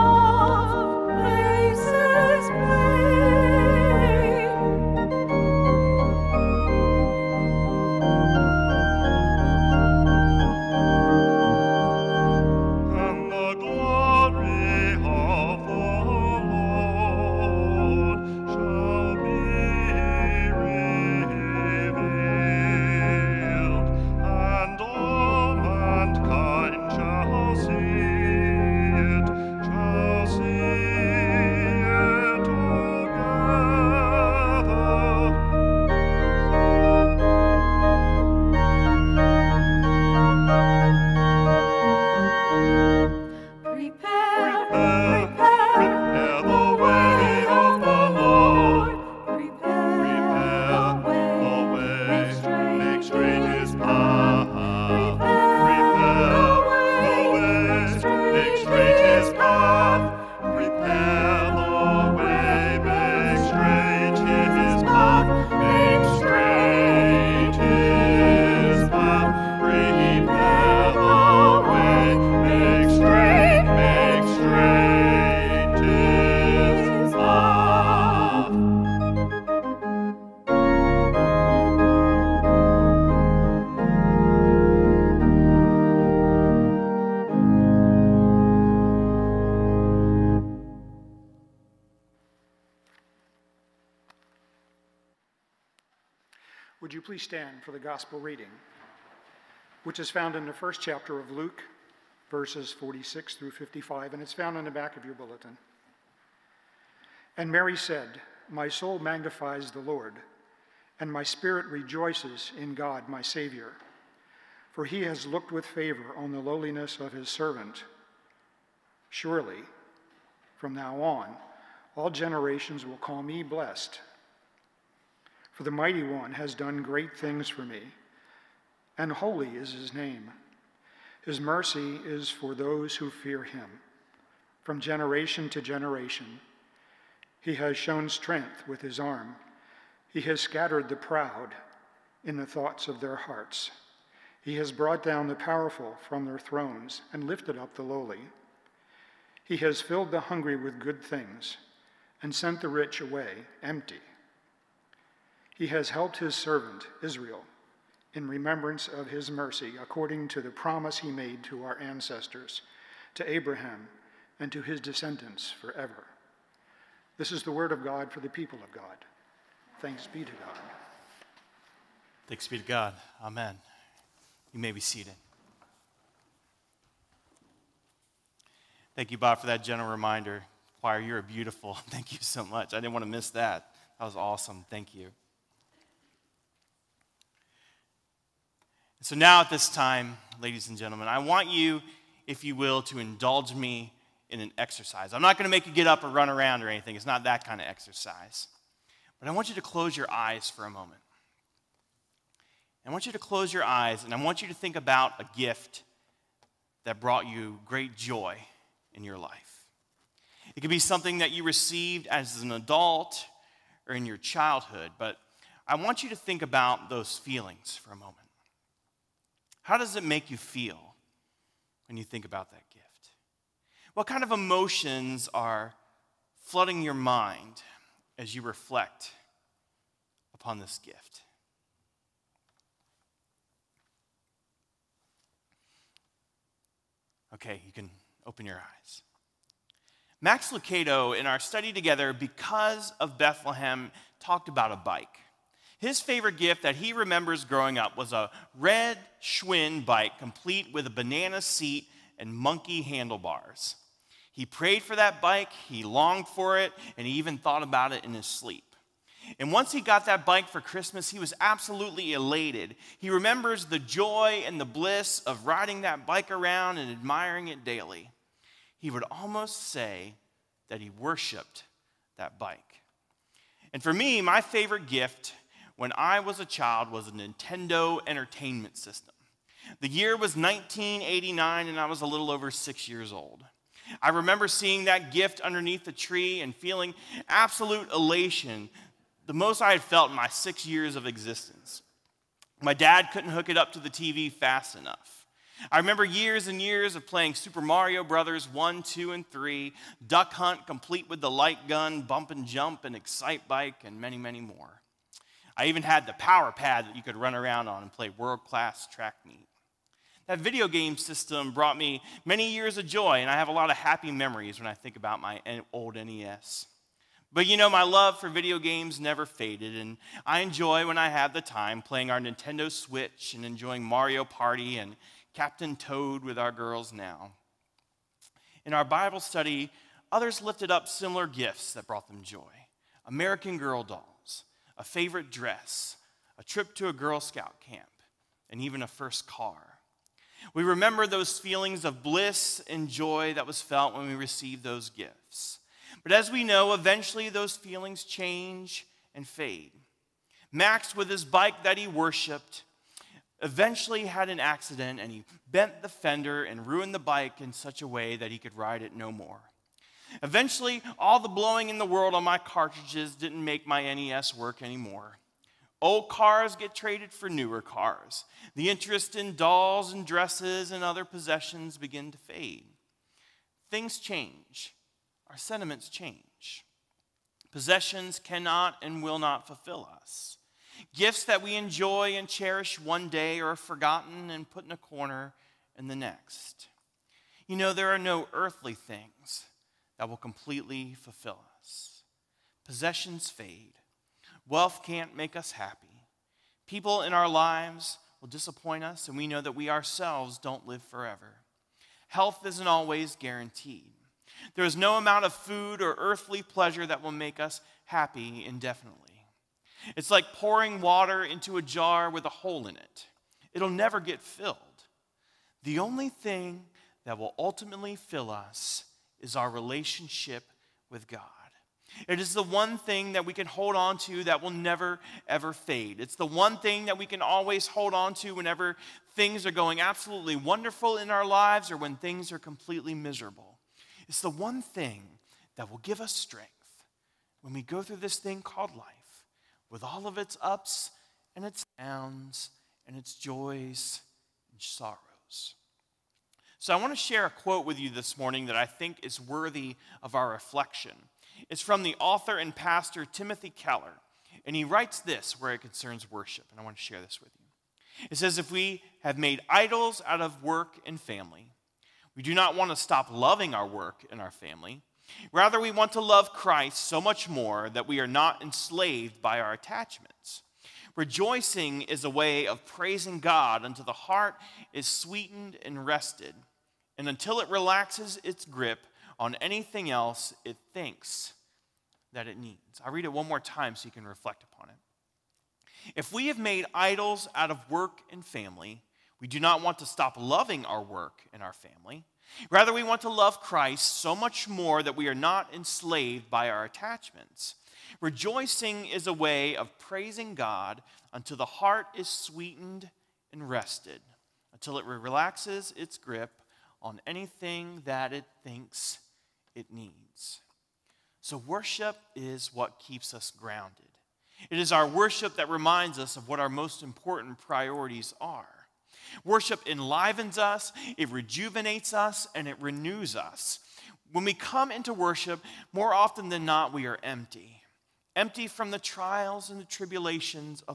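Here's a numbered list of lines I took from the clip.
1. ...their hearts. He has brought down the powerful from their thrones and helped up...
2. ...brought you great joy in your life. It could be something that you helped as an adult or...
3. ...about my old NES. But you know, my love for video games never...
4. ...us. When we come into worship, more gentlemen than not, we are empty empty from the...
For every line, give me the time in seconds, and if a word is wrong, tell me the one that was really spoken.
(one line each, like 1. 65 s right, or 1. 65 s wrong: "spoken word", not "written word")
1. 143 s wrong: "lifted", not "helped"
2. 207 s wrong: "received", not "helped"
3. 314 s right
4. 523 s wrong: "often", not "gentlemen".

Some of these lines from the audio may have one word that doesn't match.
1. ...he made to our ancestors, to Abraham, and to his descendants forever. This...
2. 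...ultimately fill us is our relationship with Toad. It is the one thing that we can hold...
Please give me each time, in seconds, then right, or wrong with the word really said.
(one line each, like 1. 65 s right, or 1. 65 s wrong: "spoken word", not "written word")
1. 160 s right
2. 417 s wrong: "God", not "Toad".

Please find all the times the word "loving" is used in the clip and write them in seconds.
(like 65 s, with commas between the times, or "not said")
463 s, 490 s.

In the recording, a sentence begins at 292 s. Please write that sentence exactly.
My dad couldn't hook it up to the TV fast enough.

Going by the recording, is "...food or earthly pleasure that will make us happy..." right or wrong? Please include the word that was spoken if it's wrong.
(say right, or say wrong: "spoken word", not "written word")
right.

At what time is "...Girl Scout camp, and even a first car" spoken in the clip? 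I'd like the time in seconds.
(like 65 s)
336 s.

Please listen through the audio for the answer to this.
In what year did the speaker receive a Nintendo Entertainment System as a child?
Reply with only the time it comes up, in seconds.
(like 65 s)
280 s.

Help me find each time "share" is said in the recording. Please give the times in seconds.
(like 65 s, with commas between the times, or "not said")
446 s, 456 s.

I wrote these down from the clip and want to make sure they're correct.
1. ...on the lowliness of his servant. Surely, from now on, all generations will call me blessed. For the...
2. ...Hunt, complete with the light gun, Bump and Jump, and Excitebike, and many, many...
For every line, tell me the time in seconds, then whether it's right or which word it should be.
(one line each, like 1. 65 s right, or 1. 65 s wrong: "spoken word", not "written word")
1. 116 s right
2. 300 s right.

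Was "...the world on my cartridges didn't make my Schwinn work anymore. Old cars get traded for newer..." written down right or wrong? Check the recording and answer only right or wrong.
wrong.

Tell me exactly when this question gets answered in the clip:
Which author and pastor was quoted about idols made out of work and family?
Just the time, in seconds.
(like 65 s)
453 s.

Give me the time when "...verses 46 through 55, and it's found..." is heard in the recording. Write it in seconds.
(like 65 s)
102 s.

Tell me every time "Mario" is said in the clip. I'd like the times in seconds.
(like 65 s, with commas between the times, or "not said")
297 s, 323 s.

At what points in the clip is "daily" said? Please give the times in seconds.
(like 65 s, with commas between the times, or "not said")
267 s.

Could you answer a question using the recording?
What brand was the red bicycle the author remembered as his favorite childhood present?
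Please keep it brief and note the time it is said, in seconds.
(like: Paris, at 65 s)
Schwinn, at 249 s.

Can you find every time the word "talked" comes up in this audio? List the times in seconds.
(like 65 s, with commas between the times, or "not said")
244 s.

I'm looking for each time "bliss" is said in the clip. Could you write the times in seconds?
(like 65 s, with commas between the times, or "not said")
264 s, 342 s.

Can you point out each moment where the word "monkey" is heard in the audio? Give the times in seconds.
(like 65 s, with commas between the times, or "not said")
252 s.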